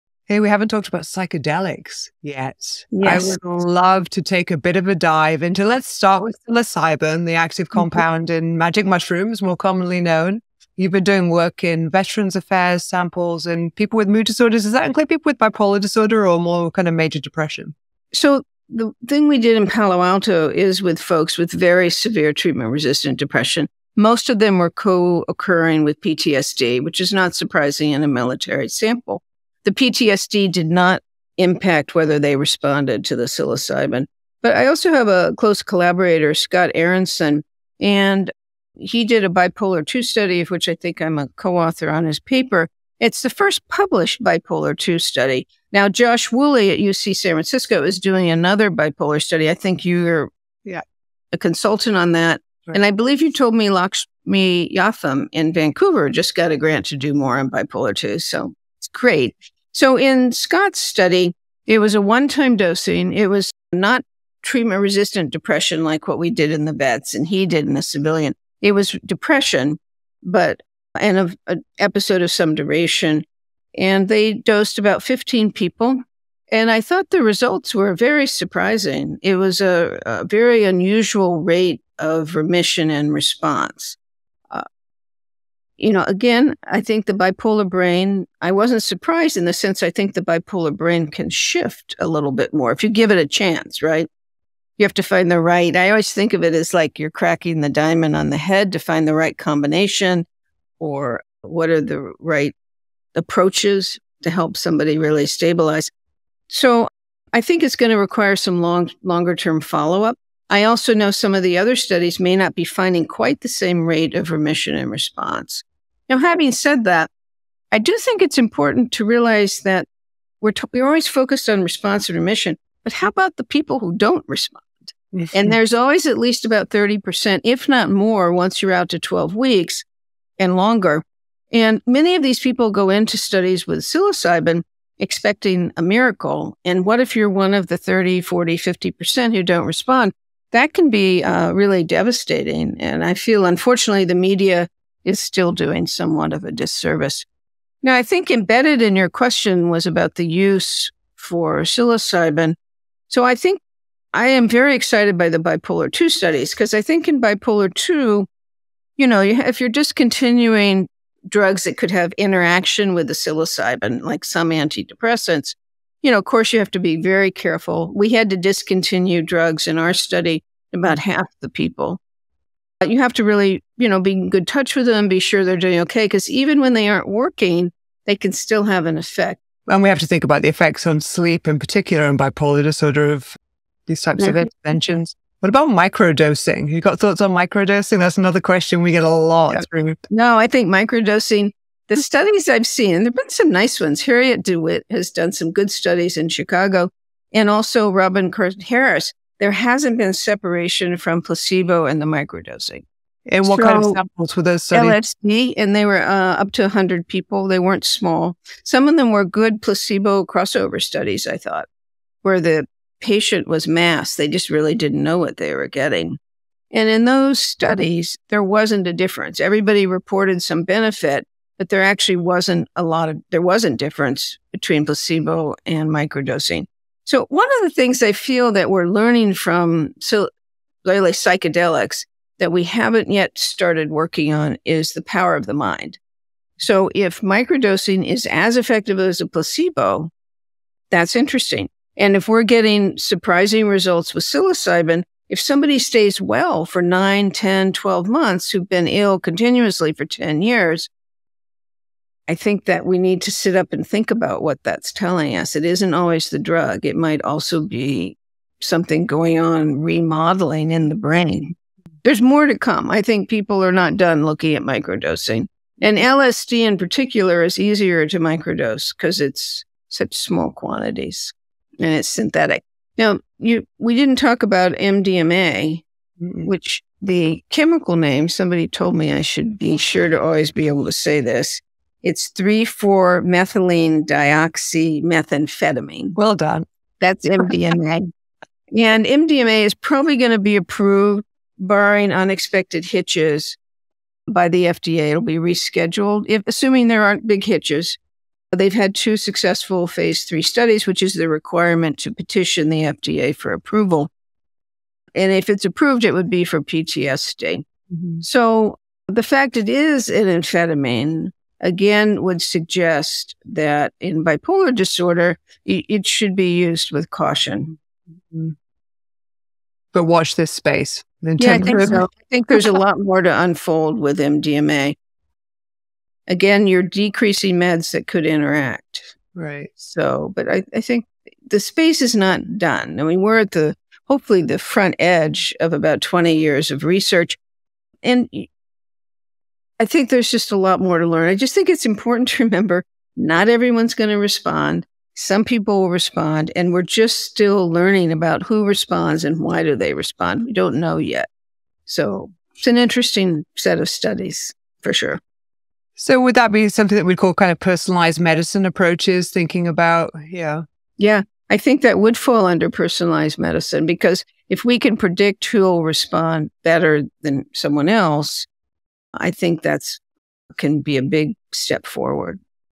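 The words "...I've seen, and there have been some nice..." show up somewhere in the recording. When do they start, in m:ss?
3:12.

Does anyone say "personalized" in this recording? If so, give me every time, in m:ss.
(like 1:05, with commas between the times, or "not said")
5:57, 6:02.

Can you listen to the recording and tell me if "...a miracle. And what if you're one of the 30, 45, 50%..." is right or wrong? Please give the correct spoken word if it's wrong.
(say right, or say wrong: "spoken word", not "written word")
wrong: "40", not "45".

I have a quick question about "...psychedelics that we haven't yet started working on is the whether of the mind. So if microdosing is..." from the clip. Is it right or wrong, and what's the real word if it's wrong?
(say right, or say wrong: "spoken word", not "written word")
wrong: "power", not "whether".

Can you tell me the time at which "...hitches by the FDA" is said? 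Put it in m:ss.
4:52.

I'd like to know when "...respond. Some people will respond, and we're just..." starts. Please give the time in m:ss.
5:44.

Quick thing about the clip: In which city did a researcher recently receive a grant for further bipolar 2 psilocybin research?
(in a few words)
Vancouver.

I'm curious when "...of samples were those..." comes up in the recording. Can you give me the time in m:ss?
3:23.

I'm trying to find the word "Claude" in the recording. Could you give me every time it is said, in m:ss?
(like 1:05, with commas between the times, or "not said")
not said.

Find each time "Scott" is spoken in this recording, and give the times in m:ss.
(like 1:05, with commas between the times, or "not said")
0:36, 1:00.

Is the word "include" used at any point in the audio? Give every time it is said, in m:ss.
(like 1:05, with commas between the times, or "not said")
0:14.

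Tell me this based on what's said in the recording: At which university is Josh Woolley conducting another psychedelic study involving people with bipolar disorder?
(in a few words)
UC San Francisco.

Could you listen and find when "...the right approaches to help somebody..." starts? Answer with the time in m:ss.
1:41.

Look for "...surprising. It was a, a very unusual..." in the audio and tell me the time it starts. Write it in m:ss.
1:18.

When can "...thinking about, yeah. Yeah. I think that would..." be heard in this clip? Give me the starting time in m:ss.
5:59.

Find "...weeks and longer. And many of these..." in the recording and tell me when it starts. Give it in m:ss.
2:09.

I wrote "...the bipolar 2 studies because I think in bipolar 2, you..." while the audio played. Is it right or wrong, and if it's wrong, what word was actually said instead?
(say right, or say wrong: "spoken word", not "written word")
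right.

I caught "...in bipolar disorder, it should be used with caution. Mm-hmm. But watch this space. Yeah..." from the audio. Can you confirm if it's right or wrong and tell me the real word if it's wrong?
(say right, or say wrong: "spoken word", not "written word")
right.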